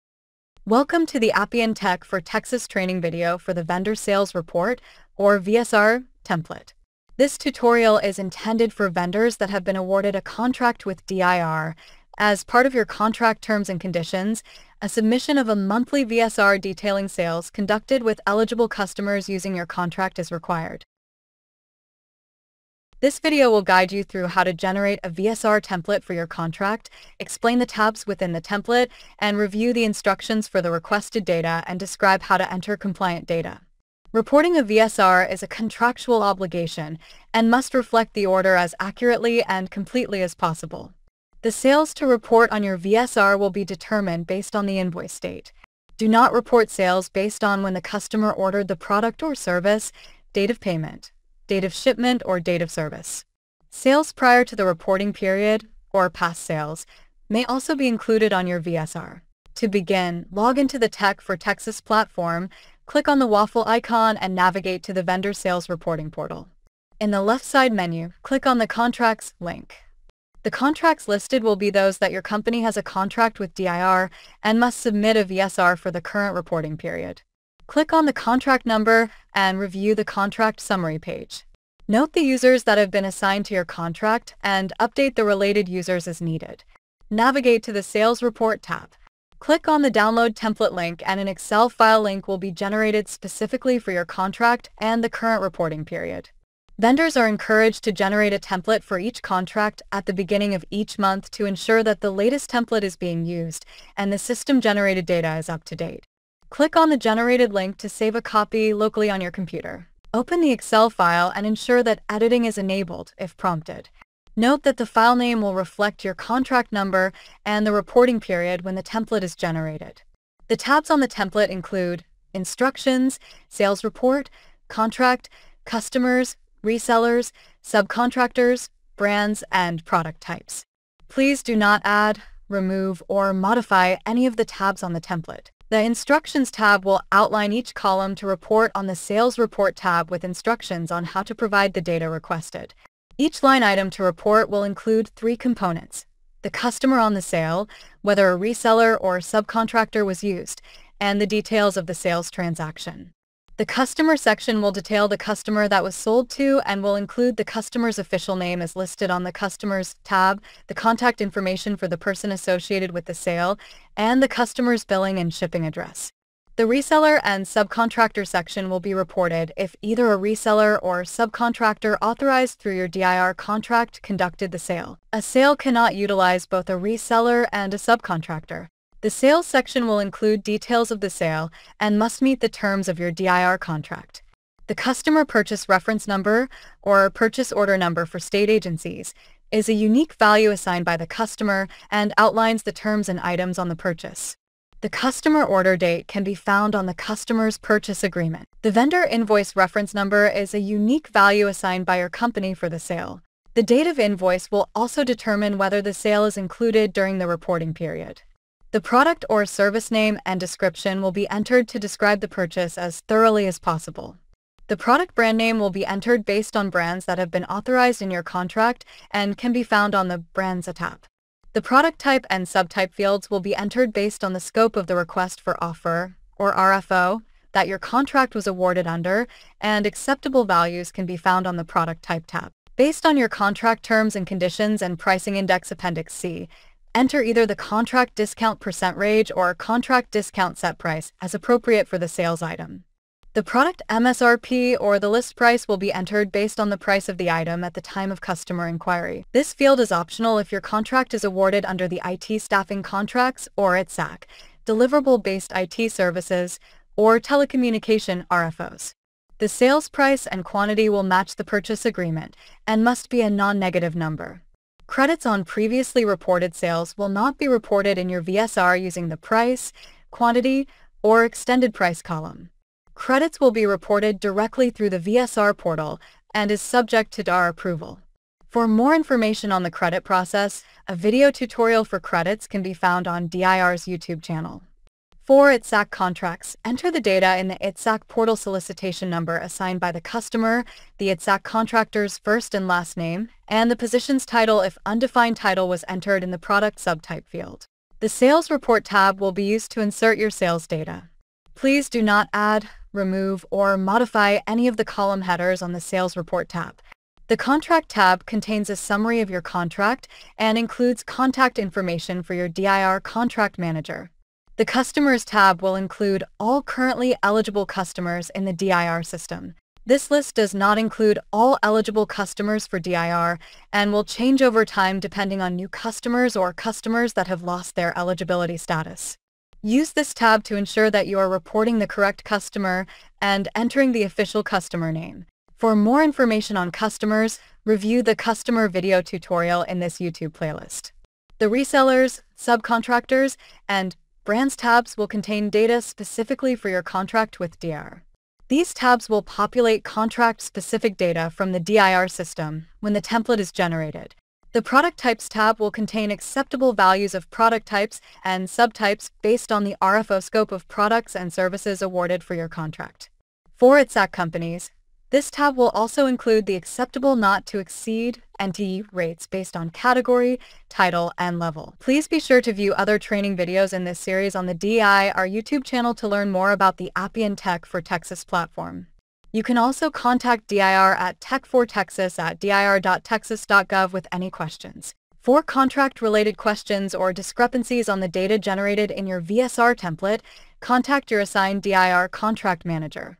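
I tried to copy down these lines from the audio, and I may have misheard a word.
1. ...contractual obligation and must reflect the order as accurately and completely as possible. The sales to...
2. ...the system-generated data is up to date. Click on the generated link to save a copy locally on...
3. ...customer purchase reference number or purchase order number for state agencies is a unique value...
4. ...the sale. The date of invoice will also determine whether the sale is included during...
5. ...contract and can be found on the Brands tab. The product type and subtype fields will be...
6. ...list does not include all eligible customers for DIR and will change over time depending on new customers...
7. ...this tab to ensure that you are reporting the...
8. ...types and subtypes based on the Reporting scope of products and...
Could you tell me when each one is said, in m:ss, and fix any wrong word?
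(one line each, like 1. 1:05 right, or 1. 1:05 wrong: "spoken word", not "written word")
1. 0:35 right
2. 1:44 right
3. 3:04 right
4. 3:22 right
5. 3:38 right
6. 5:20 right
7. 5:29 right
8. 5:57 wrong: "RFO", not "Reporting".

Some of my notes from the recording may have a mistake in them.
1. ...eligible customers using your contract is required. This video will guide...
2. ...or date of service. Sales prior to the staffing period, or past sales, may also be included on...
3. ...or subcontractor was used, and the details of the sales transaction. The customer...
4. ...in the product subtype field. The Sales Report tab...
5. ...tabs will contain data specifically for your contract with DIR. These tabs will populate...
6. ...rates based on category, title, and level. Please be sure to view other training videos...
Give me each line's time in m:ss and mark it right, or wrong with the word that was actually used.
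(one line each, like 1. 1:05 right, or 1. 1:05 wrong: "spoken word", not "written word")
1. 0:18 right
2. 0:52 wrong: "reporting", not "staffing"
3. 2:28 right
4. 4:56 right
5. 5:44 right
6. 6:08 right.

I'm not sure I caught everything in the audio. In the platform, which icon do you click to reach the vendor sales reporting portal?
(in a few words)
Waffle icon.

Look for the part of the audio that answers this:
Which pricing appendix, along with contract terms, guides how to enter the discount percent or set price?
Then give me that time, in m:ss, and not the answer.
3:55.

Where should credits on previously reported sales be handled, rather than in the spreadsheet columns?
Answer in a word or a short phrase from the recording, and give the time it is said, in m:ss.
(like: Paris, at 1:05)
VSR portal, at 4:34.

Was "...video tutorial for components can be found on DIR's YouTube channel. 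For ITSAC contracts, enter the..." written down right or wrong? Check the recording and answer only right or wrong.
wrong.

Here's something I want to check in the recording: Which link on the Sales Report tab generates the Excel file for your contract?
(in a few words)
Download Template.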